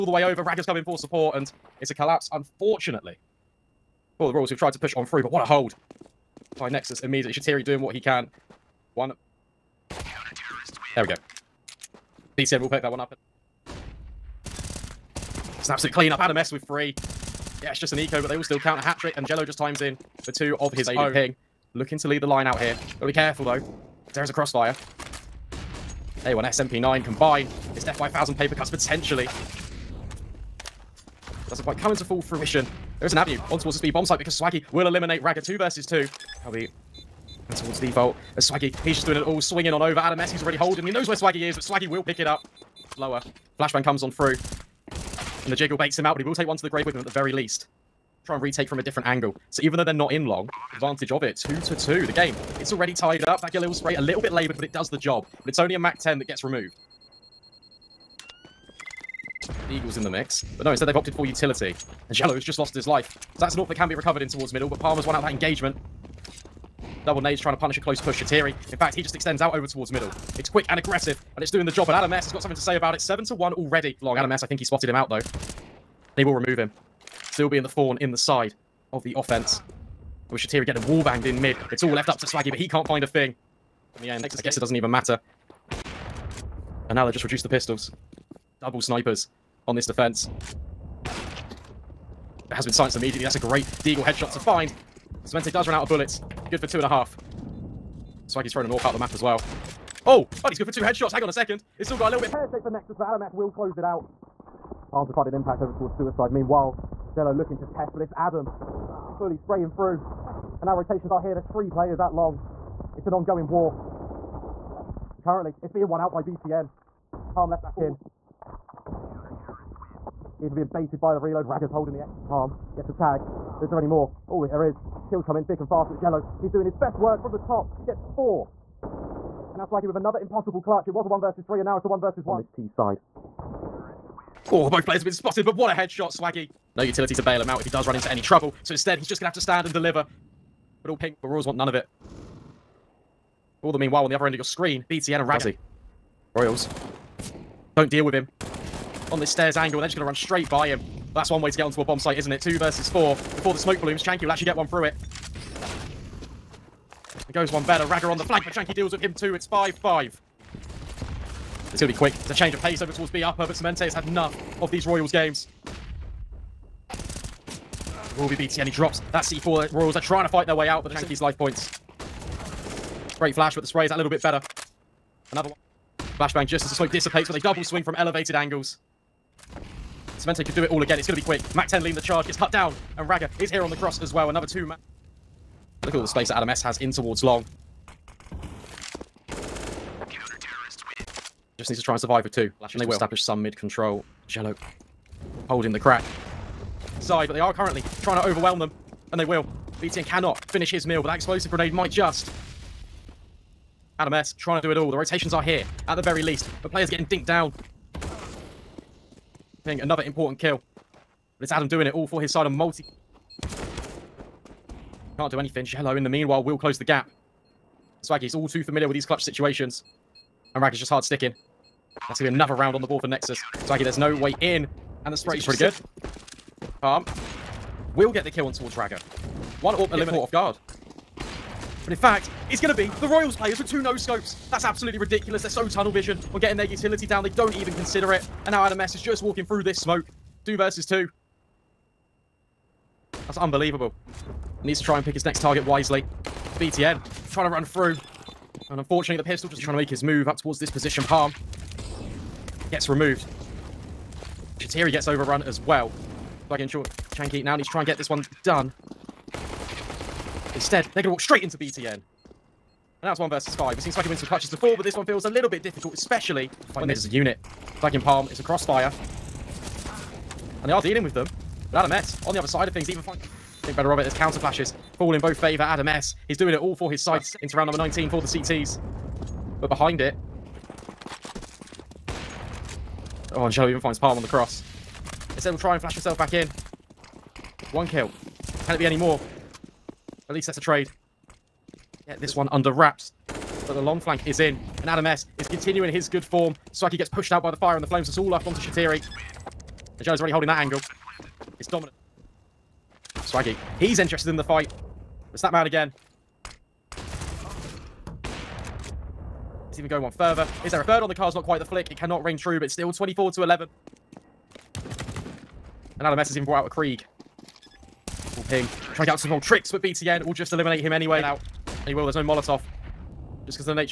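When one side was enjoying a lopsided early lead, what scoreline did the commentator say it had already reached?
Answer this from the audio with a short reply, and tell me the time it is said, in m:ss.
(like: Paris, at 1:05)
7-1, at 1:12.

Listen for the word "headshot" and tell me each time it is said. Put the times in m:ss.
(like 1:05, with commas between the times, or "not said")
1:34, 1:40, 2:15.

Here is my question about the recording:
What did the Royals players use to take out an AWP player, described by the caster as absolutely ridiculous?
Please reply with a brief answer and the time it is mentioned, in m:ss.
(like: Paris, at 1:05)
Two no-scopes, at 3:53.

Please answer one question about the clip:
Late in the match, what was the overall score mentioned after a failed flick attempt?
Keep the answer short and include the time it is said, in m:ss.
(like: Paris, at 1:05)
24-11, at 5:12.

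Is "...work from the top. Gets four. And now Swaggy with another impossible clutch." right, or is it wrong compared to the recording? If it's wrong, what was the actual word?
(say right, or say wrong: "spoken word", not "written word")
right.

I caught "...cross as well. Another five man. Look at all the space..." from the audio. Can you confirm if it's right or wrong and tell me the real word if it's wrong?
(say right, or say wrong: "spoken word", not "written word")
wrong: "two", not "five".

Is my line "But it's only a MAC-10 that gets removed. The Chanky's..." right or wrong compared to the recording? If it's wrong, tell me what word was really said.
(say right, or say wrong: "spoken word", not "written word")
wrong: "Eagle", not "Chanky".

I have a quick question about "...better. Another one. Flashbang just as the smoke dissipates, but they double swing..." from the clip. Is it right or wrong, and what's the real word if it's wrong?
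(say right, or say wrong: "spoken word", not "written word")
right.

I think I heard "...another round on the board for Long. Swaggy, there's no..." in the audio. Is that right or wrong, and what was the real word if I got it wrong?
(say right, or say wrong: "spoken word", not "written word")
wrong: "Nexus", not "Long".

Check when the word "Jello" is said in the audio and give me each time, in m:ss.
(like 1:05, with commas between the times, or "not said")
0:19, 1:02, 1:47, 2:05, 3:35.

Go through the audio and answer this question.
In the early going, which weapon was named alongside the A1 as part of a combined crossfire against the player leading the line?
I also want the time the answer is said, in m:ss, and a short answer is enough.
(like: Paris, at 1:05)
SMP9, at 0:26.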